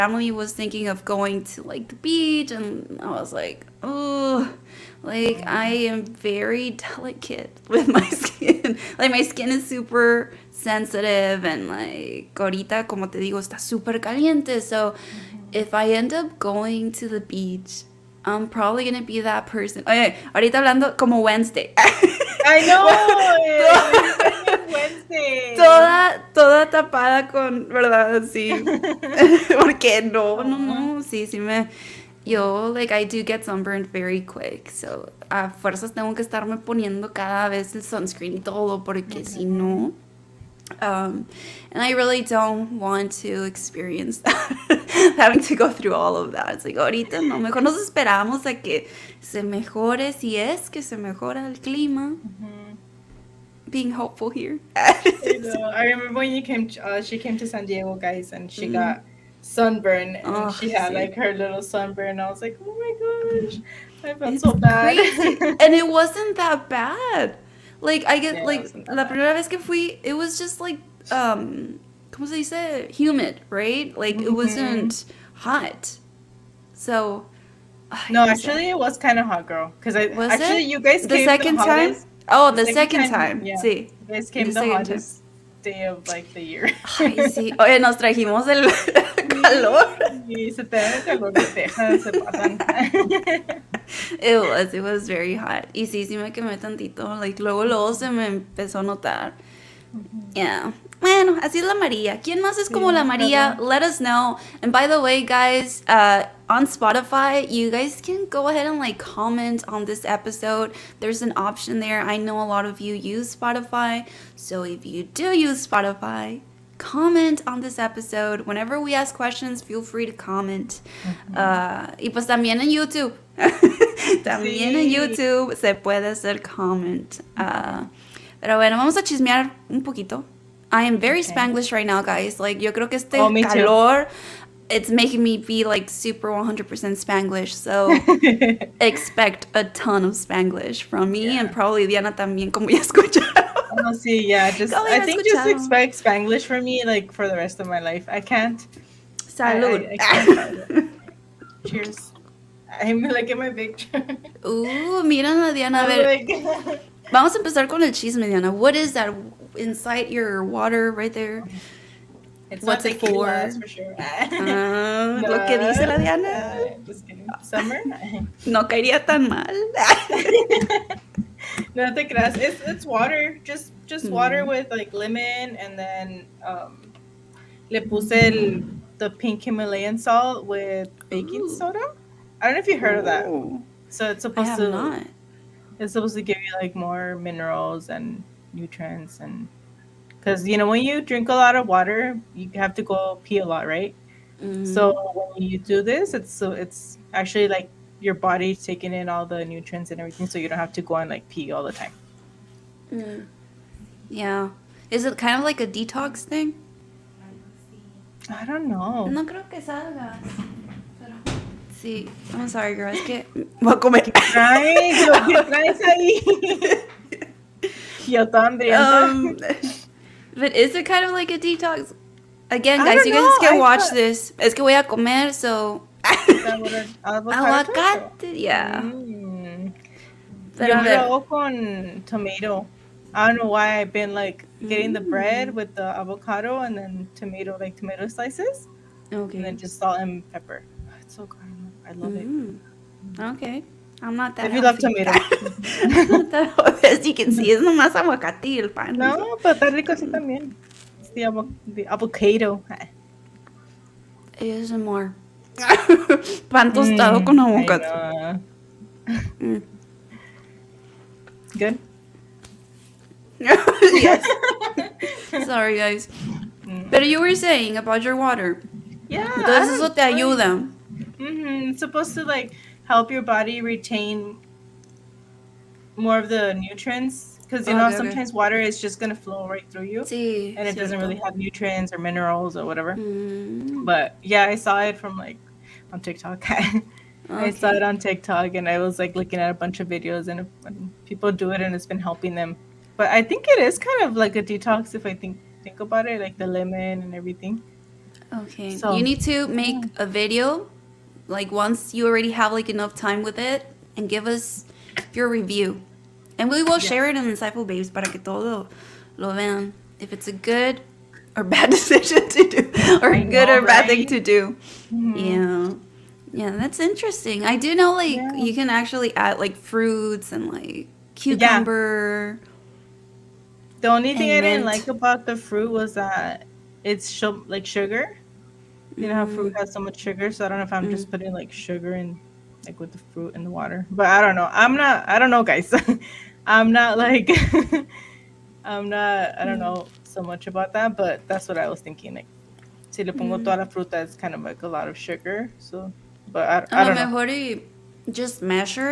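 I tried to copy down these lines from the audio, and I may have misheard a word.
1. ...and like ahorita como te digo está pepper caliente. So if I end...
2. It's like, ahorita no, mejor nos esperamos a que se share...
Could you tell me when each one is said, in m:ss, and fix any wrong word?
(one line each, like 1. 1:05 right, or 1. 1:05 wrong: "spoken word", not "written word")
1. 0:11 wrong: "super", not "pepper"
2. 0:46 wrong: "mejore", not "share".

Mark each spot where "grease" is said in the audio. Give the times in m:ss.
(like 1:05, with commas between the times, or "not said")
not said.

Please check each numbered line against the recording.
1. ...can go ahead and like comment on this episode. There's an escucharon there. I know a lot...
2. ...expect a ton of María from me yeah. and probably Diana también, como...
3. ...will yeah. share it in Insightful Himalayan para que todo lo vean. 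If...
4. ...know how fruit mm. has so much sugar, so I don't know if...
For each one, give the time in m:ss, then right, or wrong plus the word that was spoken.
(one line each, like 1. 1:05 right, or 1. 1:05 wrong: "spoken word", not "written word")
1. 1:48 wrong: "option", not "escucharon"
2. 2:18 wrong: "Spanglish", not "María"
3. 5:06 wrong: "Babes", not "Himalayan"
4. 5:29 right.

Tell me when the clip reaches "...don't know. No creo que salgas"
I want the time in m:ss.
3:28.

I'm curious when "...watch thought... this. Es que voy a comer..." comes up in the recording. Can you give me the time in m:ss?
3:43.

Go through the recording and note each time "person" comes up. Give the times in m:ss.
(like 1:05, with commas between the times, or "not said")
0:19.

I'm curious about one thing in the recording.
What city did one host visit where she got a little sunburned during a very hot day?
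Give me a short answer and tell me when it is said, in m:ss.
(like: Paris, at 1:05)
San Diego, at 0:57.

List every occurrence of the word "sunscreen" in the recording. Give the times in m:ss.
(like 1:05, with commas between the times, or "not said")
0:37.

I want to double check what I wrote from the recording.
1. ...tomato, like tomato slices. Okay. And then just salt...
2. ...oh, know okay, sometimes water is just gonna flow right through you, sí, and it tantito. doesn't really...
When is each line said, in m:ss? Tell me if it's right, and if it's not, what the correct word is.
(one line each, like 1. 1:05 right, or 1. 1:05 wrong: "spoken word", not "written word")
1. 3:57 right
2. 4:37 wrong: "cierto", not "tantito".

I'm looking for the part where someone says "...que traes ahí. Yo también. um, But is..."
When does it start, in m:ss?
3:35.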